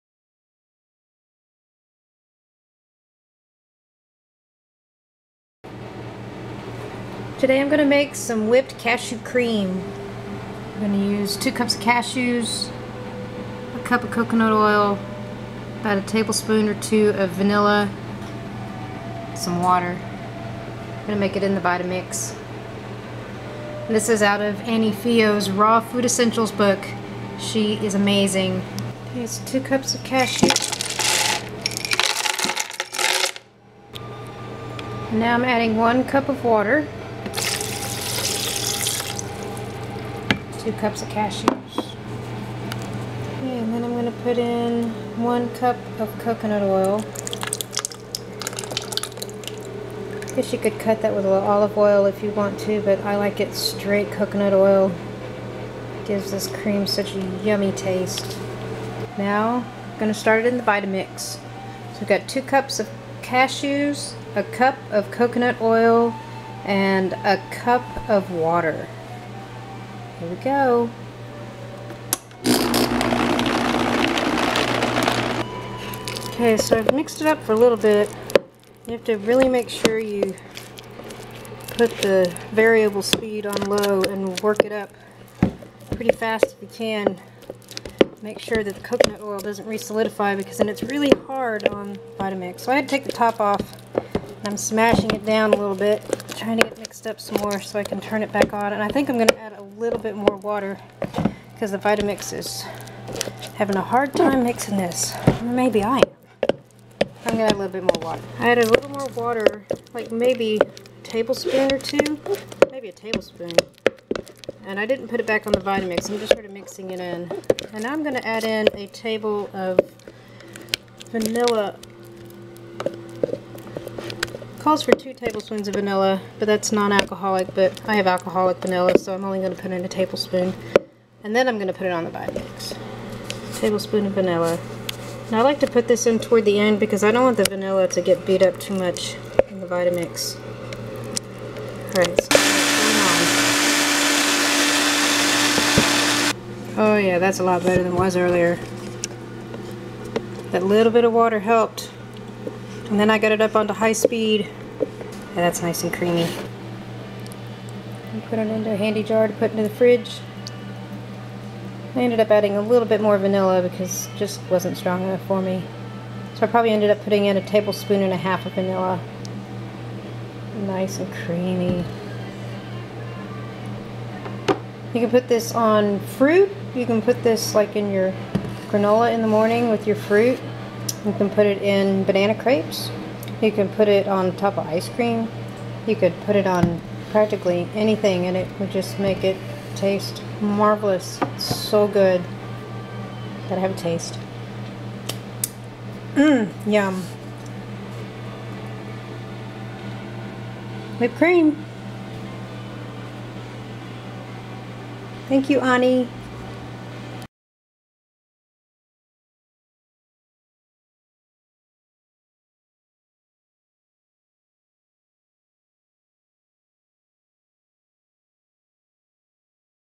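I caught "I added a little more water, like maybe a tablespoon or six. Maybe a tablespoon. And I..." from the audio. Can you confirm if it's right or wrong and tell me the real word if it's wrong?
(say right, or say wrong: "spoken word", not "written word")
wrong: "two", not "six".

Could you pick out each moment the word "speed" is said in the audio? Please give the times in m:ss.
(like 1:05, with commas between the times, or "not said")
1:23, 2:33.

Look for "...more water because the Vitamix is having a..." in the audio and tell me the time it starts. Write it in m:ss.
1:40.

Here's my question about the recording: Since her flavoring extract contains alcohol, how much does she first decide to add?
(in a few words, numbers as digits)
1 tablespoon.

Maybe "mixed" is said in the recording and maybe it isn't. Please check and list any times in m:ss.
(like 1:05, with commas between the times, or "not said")
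1:16, 1:36.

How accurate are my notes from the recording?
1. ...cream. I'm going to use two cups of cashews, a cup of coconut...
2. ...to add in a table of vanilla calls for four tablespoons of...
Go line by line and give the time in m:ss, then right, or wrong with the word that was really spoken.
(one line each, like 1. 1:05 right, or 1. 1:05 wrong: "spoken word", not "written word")
1. 0:09 right
2. 1:58 wrong: "two", not "four".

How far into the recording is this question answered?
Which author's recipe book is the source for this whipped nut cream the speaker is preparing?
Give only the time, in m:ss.
0:24.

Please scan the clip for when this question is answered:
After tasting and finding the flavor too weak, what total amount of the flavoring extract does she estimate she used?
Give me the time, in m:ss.
2:47.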